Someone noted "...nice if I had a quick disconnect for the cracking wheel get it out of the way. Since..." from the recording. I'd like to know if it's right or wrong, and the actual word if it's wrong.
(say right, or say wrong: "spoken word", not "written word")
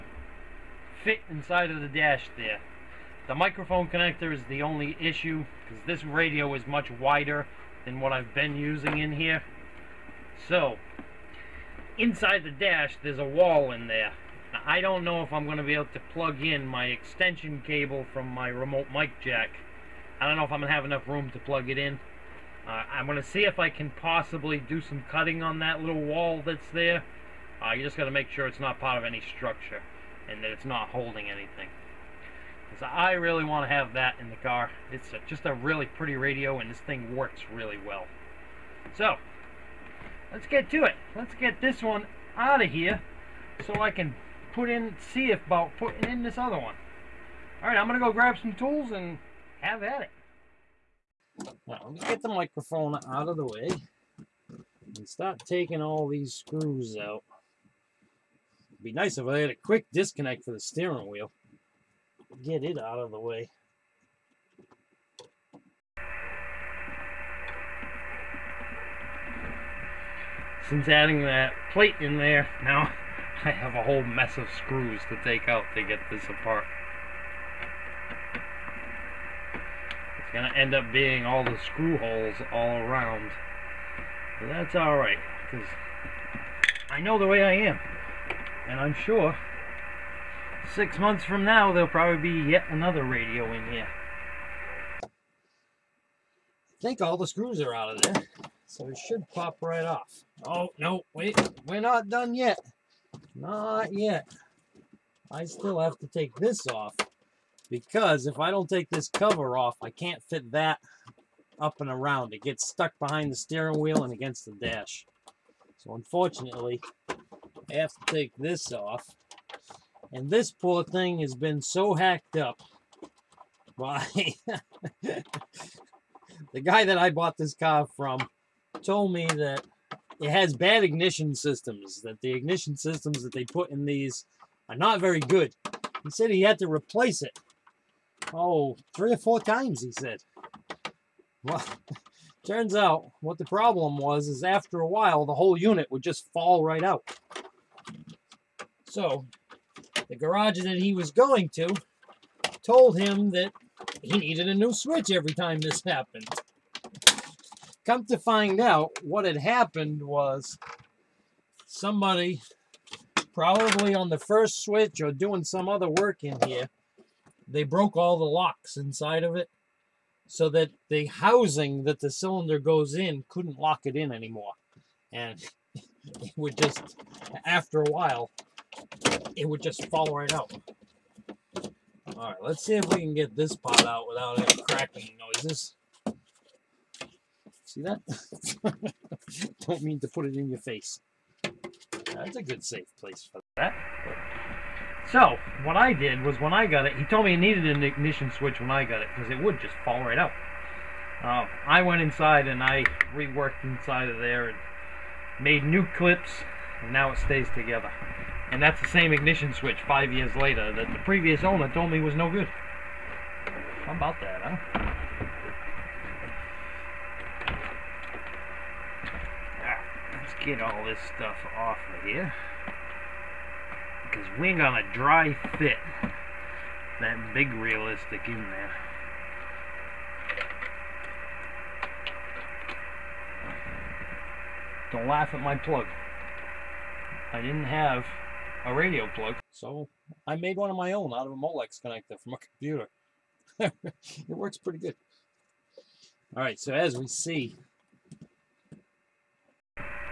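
wrong: "steering", not "cracking".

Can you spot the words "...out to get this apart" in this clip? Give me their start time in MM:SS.
01:15.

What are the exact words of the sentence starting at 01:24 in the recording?
But that's alright, because I know the way I am.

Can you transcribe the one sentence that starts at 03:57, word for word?
I didn't have a radio plug.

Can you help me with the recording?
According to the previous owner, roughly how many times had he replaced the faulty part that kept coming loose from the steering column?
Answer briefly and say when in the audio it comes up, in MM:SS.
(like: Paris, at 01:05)
3 or 4 times, at 02:18.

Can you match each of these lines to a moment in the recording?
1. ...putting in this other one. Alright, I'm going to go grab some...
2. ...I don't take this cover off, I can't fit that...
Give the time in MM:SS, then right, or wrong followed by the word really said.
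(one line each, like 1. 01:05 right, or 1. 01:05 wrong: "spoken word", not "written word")
1. 00:45 right
2. 01:48 right.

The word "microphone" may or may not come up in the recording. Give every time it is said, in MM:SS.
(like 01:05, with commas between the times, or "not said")
00:03, 00:52.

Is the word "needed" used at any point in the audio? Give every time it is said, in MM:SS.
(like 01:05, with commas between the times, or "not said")
02:34, 03:17.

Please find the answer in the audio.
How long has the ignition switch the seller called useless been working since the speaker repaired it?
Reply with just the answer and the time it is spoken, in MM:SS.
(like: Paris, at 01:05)
5 years, at 03:29.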